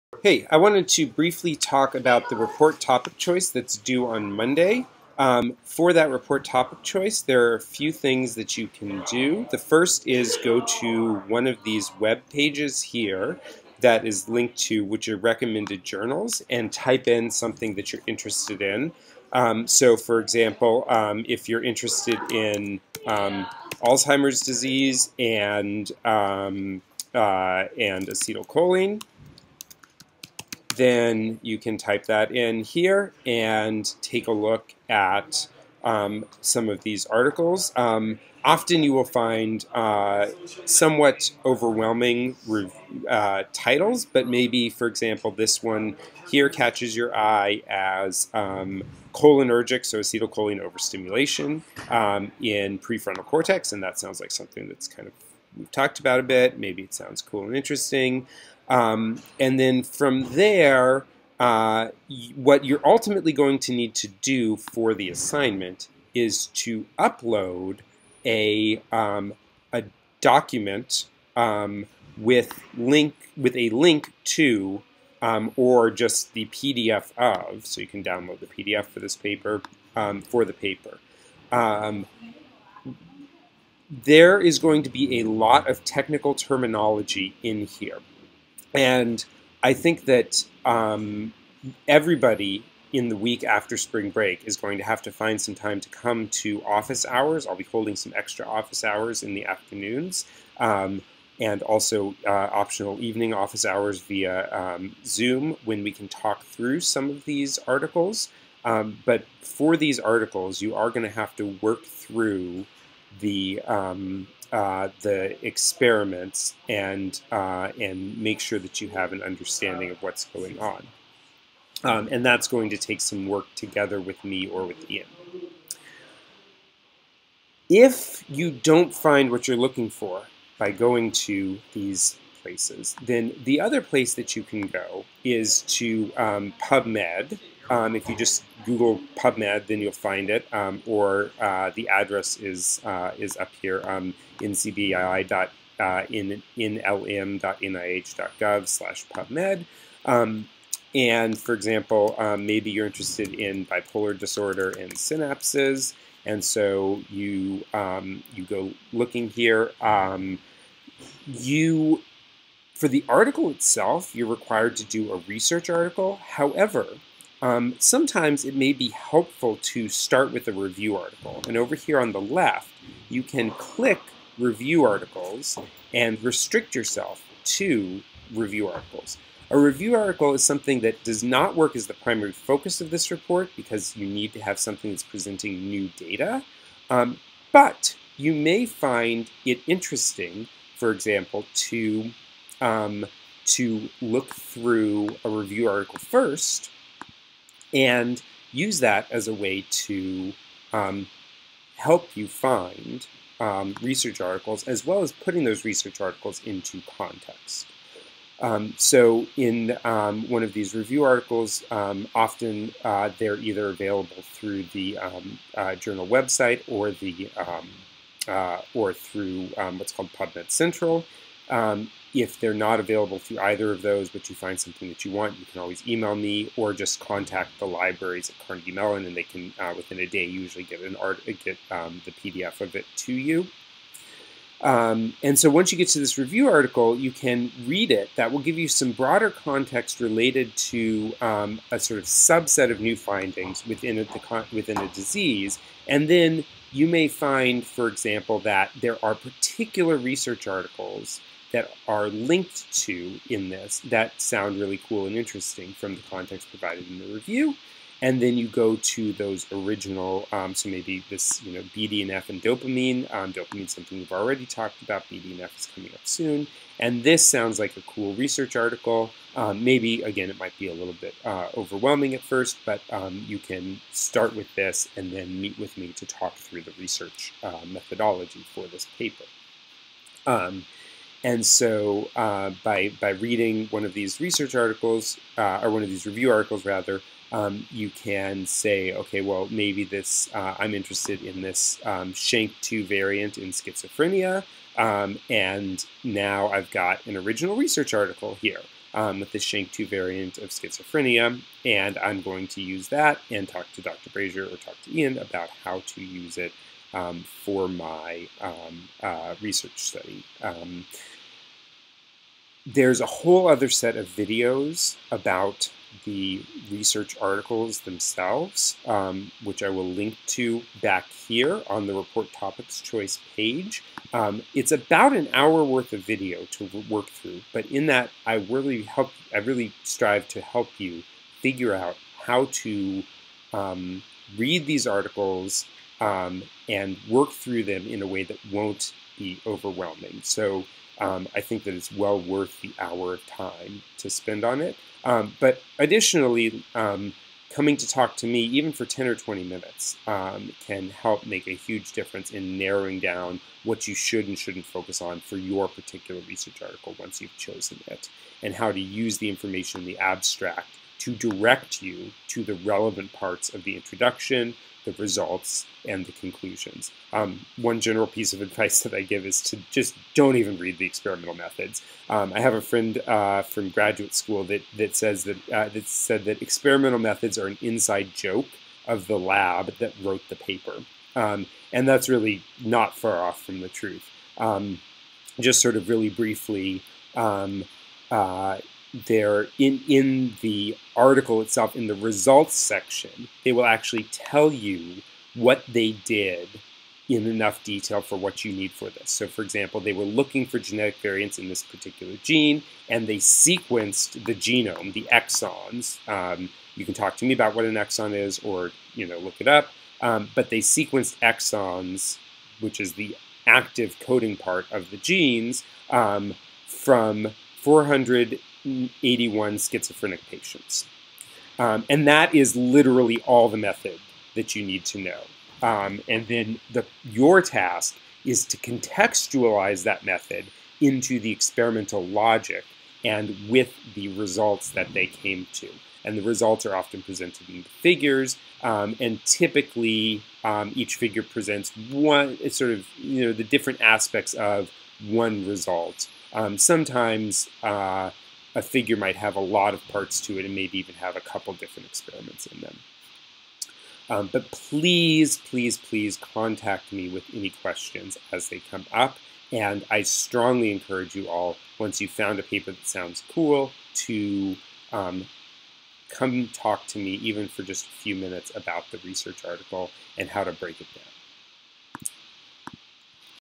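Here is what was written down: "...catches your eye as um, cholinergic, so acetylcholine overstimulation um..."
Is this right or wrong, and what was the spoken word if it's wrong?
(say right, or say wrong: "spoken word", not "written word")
right.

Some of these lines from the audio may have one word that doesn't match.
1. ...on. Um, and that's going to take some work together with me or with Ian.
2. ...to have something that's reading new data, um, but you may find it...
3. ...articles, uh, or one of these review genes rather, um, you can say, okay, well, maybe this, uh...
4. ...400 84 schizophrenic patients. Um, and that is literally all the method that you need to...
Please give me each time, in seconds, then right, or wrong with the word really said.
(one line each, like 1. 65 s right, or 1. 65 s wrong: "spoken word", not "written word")
1. 120 s right
2. 184 s wrong: "presenting", not "reading"
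3. 284 s wrong: "articles", not "genes"
4. 417 s wrong: "81", not "84".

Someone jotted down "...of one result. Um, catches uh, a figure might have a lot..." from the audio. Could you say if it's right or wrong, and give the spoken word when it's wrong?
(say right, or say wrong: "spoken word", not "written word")
wrong: "sometimes", not "catches".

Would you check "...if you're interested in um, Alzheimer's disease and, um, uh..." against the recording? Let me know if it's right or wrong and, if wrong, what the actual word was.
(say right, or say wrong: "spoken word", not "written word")
right.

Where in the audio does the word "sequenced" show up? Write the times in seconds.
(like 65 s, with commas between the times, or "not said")
403 s, 410 s.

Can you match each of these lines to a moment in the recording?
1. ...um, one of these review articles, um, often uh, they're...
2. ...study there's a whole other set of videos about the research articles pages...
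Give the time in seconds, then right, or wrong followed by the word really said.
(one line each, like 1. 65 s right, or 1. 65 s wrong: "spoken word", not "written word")
1. 209 s right
2. 309 s wrong: "themselves", not "pages".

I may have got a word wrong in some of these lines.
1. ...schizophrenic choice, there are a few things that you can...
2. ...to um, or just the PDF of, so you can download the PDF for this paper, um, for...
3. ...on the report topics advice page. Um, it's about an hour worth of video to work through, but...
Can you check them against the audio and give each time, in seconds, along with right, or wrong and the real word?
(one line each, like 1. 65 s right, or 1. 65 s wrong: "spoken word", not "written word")
1. 6 s wrong: "topic", not "schizophrenic"
2. 74 s right
3. 321 s wrong: "choice", not "advice".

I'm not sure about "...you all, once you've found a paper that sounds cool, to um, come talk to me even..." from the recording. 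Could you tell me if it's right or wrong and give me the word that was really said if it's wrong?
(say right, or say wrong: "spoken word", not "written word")
right.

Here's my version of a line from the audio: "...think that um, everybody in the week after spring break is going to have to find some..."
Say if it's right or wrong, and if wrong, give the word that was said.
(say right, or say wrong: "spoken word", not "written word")
right.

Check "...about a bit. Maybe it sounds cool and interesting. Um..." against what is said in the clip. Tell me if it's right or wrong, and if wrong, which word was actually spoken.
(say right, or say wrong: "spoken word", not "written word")
right.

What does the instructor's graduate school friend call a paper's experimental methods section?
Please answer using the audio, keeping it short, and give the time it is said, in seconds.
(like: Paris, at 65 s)
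an inside joke, at 377 s.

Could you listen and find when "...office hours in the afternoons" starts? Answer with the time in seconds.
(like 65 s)
98 s.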